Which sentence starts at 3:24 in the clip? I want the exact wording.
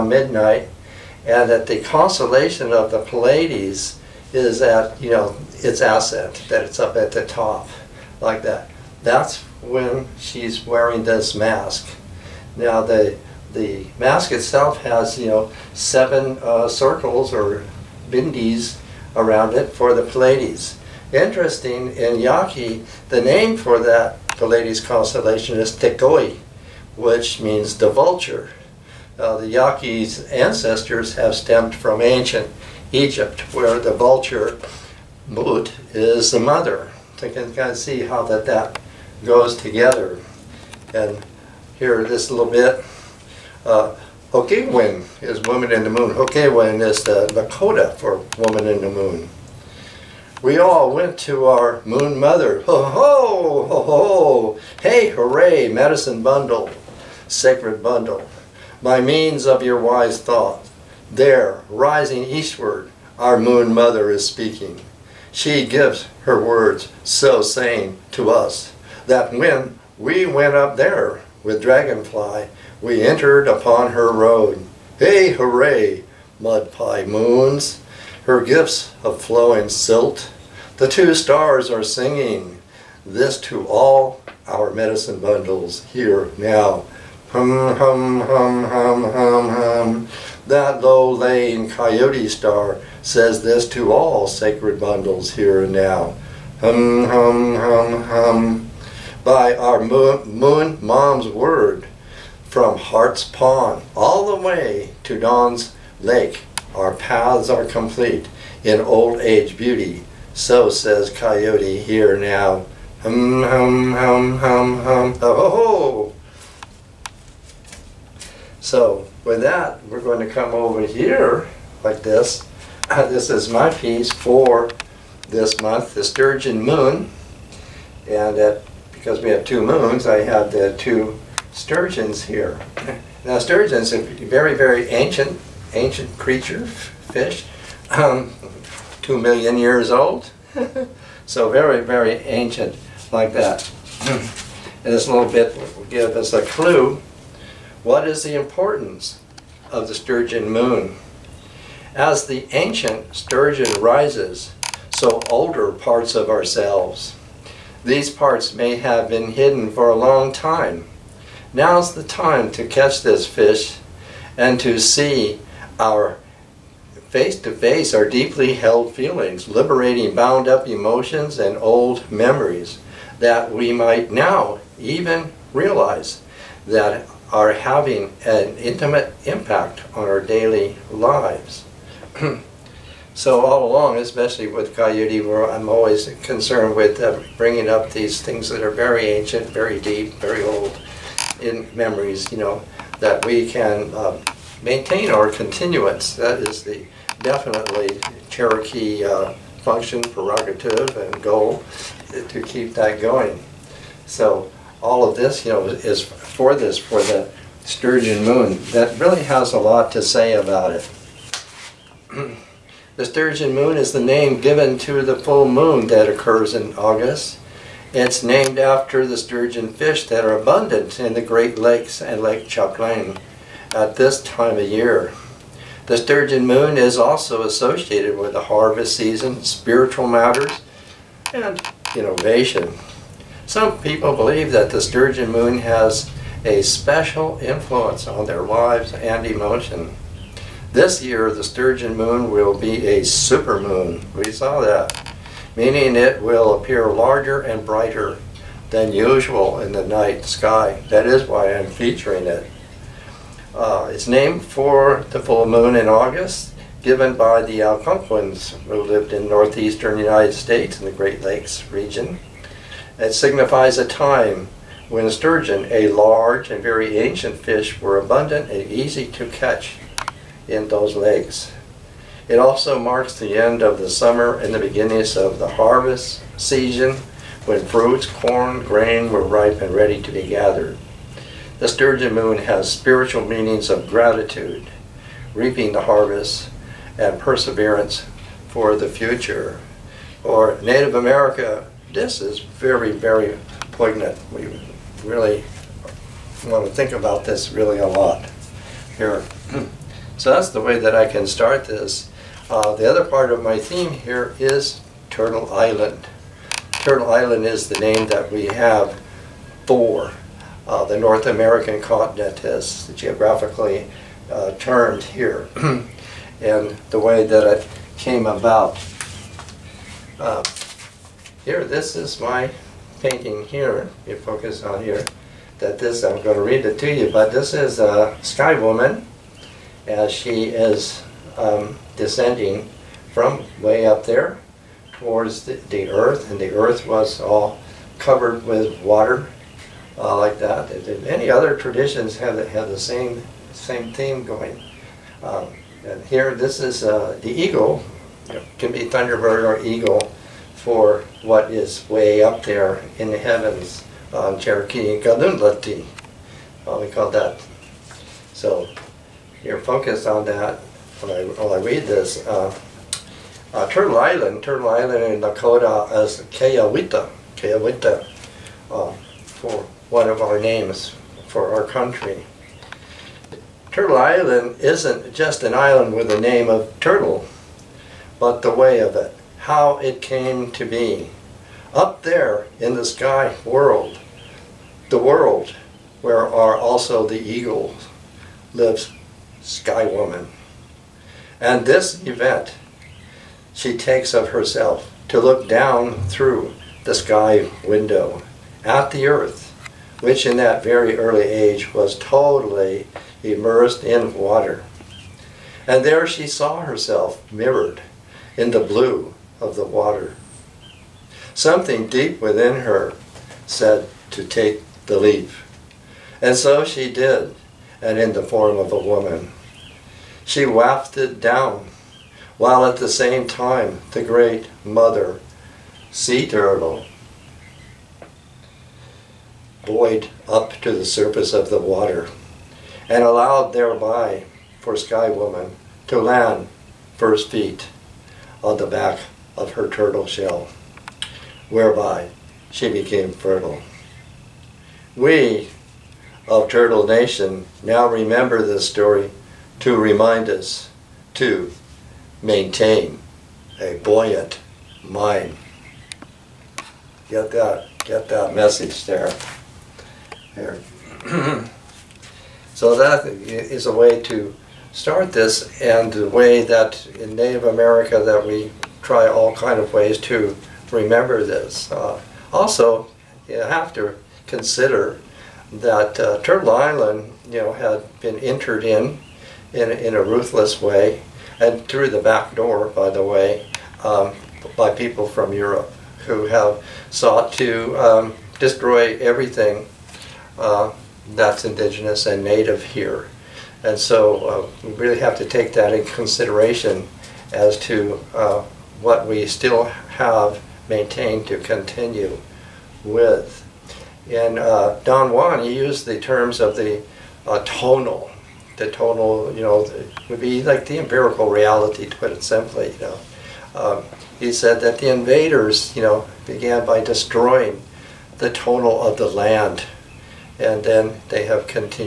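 So all of this, you know, is for this, for the sturgeon moon.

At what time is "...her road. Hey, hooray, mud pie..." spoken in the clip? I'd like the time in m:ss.
1:13.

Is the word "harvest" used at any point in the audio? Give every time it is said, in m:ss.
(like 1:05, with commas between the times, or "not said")
3:48, 4:35, 4:45.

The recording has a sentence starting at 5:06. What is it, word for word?
Turtle Island is the name that we have for uh, the North American continent as geographically uh, termed here.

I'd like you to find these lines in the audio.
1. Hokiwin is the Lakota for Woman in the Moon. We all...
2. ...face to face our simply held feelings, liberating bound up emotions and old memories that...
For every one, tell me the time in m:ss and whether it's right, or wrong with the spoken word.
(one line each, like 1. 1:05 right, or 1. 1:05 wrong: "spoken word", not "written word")
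1. 0:46 right
2. 2:47 wrong: "deeply", not "simply".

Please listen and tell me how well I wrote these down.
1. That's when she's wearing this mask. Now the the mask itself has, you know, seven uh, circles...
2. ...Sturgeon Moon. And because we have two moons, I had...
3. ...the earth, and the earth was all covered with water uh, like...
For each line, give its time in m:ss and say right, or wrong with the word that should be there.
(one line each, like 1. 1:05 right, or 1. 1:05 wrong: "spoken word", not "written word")
1. 0:09 right
2. 2:06 right
3. 5:35 right.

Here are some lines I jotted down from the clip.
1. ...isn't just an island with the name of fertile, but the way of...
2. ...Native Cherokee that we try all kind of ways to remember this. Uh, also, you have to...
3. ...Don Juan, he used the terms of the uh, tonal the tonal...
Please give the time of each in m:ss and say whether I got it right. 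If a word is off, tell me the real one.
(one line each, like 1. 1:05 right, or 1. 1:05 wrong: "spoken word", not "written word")
1. 6:14 wrong: "turtle", not "fertile"
2. 7:47 wrong: "America", not "Cherokee"
3. 8:24 right.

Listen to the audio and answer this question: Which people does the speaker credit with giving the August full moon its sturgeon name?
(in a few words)
Algonquins.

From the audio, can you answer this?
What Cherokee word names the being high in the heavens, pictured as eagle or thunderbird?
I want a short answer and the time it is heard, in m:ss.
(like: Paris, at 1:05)
Galundlati, at 5:55.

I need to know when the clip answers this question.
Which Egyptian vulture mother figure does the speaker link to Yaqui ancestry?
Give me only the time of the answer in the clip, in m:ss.
0:35.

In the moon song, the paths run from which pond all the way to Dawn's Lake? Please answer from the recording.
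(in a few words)
Hart's Pond.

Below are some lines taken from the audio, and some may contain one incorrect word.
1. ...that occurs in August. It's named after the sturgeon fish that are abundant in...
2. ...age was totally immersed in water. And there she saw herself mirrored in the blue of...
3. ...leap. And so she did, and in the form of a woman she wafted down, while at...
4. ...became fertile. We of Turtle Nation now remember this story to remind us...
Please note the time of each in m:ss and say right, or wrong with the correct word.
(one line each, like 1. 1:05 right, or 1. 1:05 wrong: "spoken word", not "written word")
1. 3:35 right
2. 6:41 right
3. 6:54 right
4. 7:22 right.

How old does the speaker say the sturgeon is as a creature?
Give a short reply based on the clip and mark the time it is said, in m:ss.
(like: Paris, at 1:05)
2 million years, at 2:19.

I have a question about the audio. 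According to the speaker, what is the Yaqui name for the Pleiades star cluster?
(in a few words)
Tekoi.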